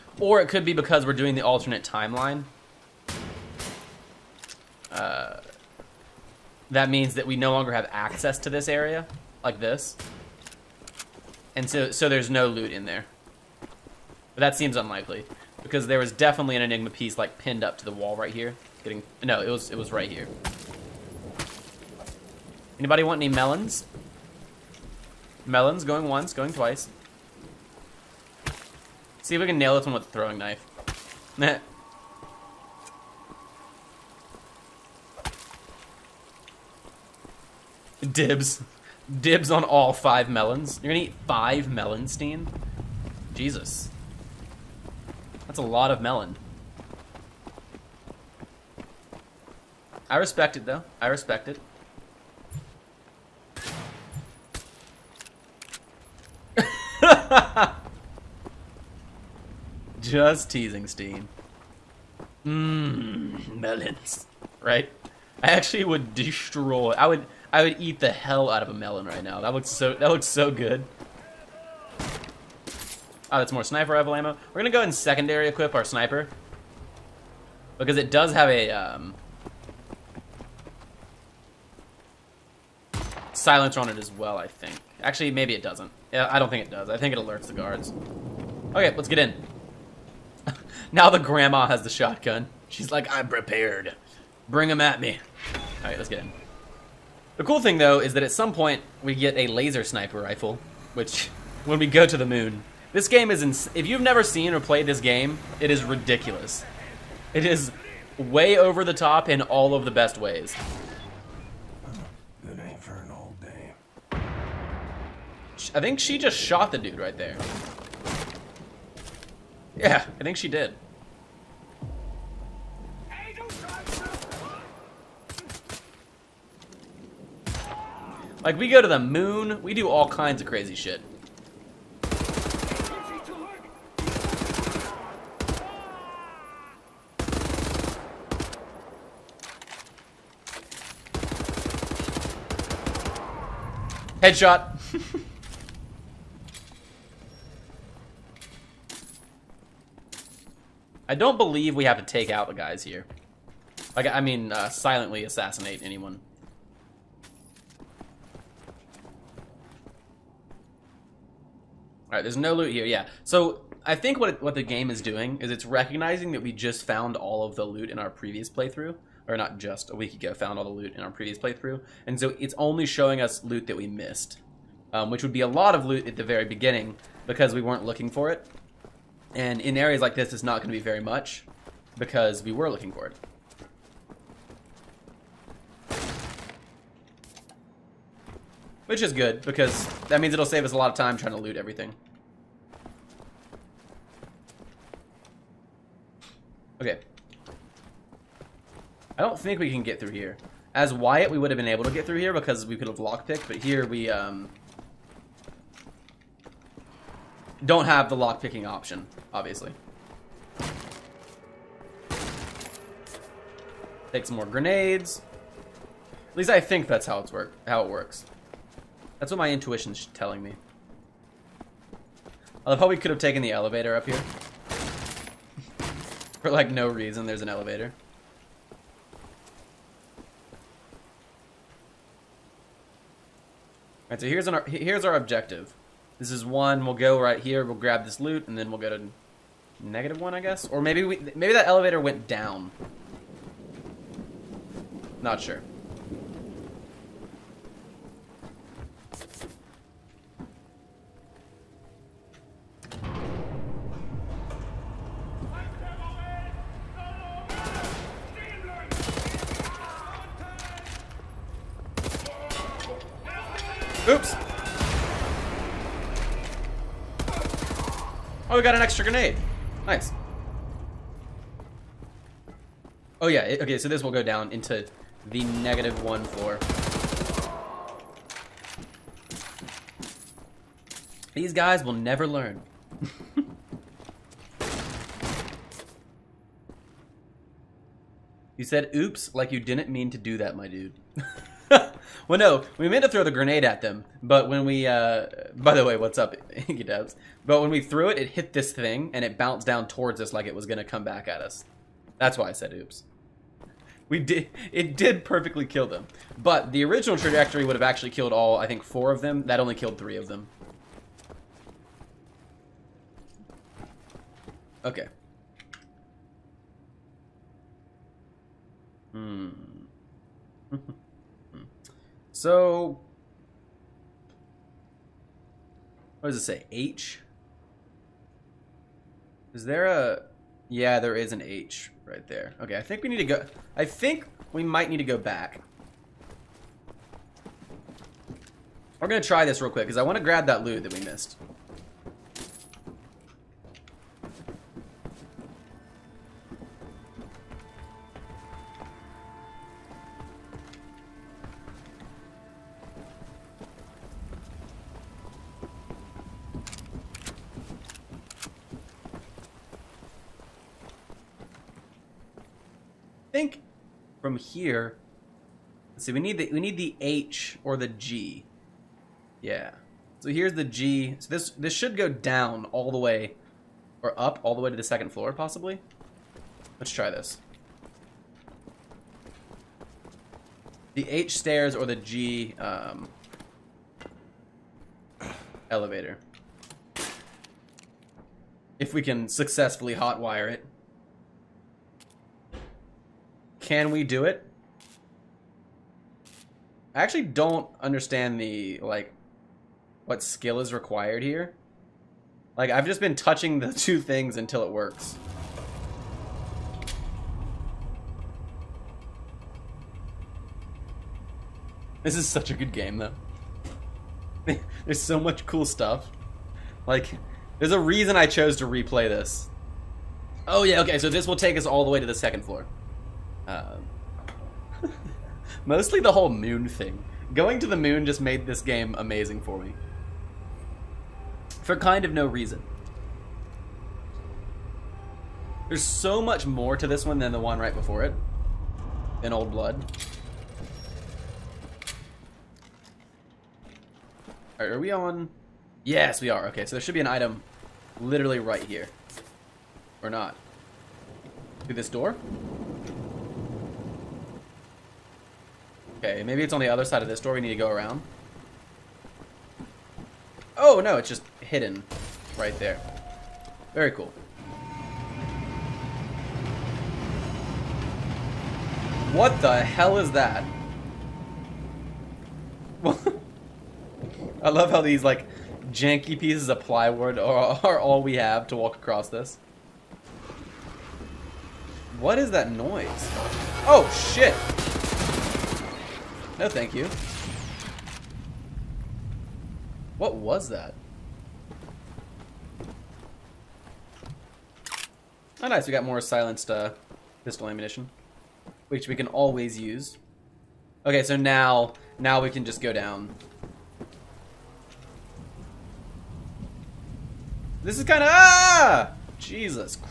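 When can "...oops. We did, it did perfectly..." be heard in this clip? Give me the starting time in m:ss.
5:02.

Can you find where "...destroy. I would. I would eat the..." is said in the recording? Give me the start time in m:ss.
1:06.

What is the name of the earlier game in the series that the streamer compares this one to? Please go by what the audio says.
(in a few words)
Old Blood.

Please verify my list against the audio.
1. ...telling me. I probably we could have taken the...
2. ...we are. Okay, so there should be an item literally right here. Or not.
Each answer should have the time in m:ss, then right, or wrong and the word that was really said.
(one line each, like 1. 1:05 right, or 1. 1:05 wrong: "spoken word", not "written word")
1. 3:40 right
2. 7:26 right.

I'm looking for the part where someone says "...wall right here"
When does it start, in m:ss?
0:17.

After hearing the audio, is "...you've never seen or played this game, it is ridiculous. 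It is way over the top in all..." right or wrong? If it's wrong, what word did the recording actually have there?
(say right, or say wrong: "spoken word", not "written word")
right.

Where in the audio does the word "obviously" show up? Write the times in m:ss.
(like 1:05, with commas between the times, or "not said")
3:29.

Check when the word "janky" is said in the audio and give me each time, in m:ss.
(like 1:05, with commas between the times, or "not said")
7:55.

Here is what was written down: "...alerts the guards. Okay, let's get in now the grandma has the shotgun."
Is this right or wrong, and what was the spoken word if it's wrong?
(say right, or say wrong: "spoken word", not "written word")
right.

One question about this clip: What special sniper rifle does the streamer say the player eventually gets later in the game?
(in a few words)
Laser sniper rifle.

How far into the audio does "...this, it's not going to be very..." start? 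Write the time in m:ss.
3:00.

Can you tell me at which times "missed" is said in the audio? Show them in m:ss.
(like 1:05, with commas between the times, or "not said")
2:53, 5:41.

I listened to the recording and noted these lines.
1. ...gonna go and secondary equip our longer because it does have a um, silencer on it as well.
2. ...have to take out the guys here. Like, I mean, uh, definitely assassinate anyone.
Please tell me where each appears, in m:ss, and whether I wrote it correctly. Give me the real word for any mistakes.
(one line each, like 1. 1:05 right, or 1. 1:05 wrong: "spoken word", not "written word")
1. 1:14 wrong: "sniper", not "longer"
2. 2:31 wrong: "silently", not "definitely".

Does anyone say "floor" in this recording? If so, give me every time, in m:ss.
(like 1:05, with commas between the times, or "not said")
4:36, 6:15, 7:02.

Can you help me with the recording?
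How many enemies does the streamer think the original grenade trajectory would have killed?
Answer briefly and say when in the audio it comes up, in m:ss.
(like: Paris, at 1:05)
4, at 5:08.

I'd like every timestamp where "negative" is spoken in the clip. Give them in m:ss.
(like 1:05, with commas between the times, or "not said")
3:59, 4:35.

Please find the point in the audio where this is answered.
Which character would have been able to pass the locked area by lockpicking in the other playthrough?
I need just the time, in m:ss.
3:20.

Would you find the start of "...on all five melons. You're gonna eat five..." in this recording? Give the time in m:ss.
0:39.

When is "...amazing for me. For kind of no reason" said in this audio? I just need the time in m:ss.
7:08.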